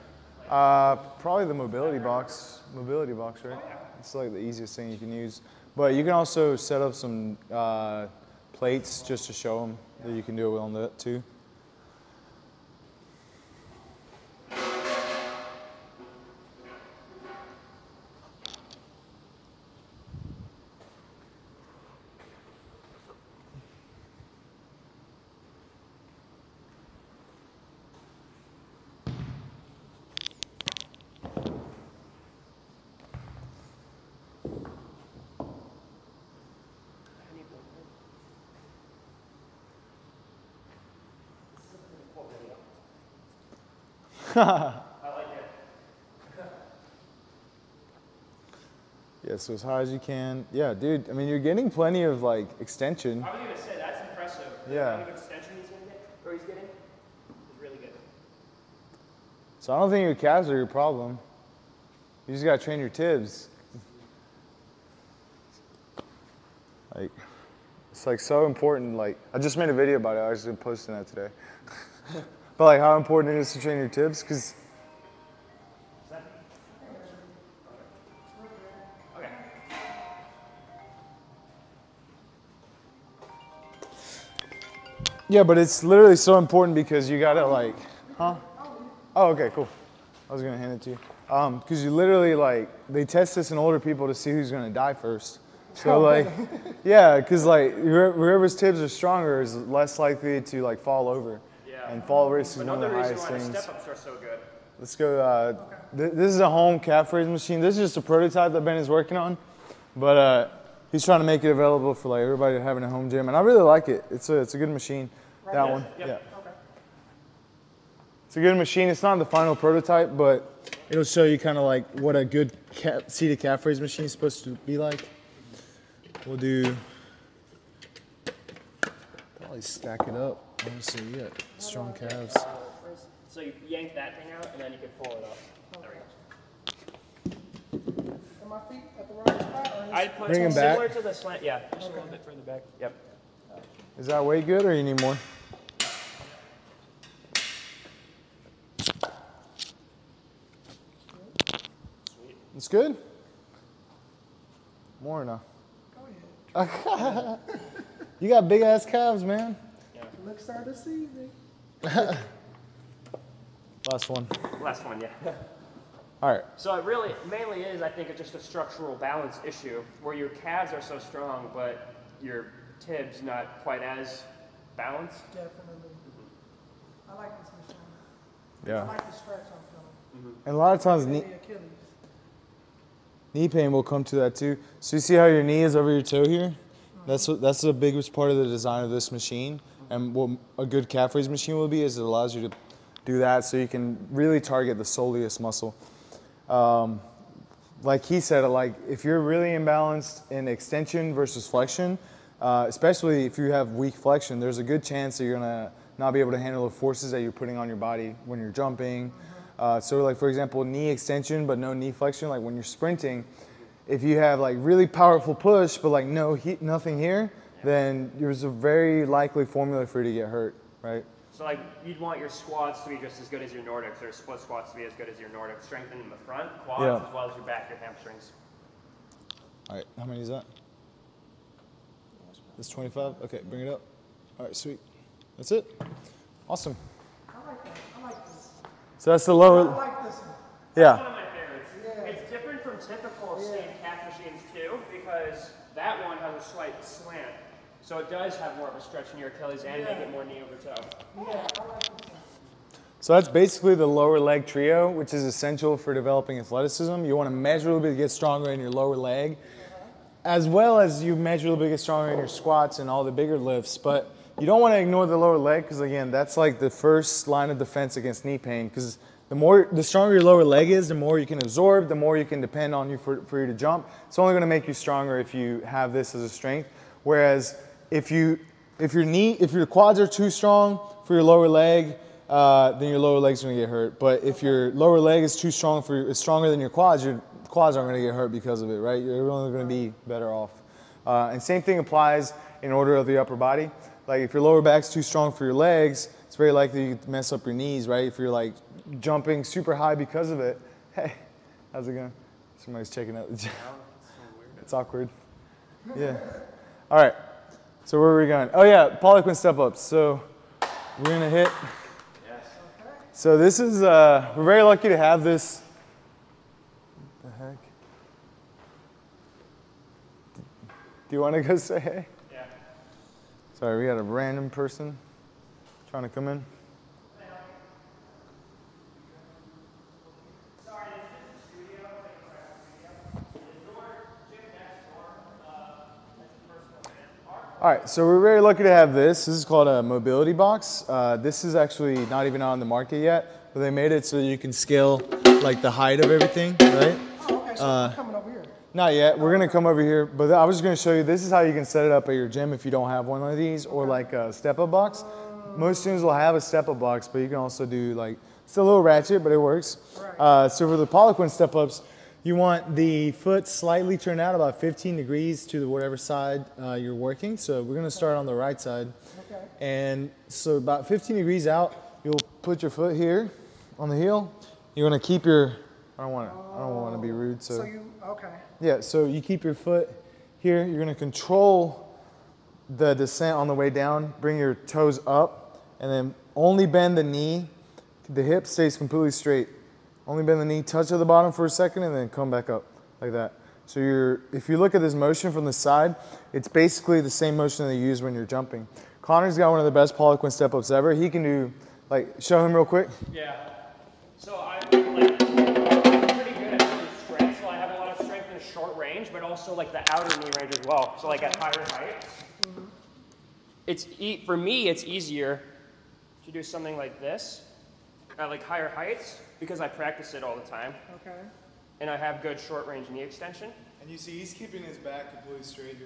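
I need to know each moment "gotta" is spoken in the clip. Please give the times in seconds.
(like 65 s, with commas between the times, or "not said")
62 s, 87 s.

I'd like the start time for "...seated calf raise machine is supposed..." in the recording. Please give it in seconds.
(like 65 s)
123 s.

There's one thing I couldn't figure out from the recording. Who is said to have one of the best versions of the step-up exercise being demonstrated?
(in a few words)
Conner.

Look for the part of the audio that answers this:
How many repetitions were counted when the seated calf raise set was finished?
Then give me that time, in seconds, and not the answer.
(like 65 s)
232 s.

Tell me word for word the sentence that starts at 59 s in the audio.
So I don't think your calves are your problem.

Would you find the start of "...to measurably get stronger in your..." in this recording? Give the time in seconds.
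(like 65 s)
257 s.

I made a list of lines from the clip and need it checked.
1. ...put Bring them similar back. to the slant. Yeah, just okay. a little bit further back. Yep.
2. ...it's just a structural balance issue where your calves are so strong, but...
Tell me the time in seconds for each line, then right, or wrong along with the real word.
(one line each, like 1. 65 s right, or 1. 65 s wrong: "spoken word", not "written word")
1. 140 s right
2. 168 s right.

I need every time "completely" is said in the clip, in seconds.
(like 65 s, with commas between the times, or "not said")
388 s, 425 s.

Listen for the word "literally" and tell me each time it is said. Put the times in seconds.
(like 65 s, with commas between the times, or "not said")
85 s, 91 s.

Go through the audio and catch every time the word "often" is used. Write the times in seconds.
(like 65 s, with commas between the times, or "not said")
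not said.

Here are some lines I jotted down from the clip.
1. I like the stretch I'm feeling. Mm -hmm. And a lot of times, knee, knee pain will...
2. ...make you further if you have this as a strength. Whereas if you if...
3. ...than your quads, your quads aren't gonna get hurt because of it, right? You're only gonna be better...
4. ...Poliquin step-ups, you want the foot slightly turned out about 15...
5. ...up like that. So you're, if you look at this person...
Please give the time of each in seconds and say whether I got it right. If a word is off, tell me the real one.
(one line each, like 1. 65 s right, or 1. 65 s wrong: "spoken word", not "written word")
1. 178 s right
2. 274 s wrong: "stronger", not "further"
3. 286 s right
4. 360 s right
5. 392 s wrong: "motion", not "person".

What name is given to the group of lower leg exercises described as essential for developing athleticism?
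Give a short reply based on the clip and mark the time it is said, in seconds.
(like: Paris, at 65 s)
lower leg trio, at 253 s.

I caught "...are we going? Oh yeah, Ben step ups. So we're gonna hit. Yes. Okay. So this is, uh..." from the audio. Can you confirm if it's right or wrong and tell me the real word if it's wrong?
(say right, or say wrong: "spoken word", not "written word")
wrong: "Poliquin", not "Ben".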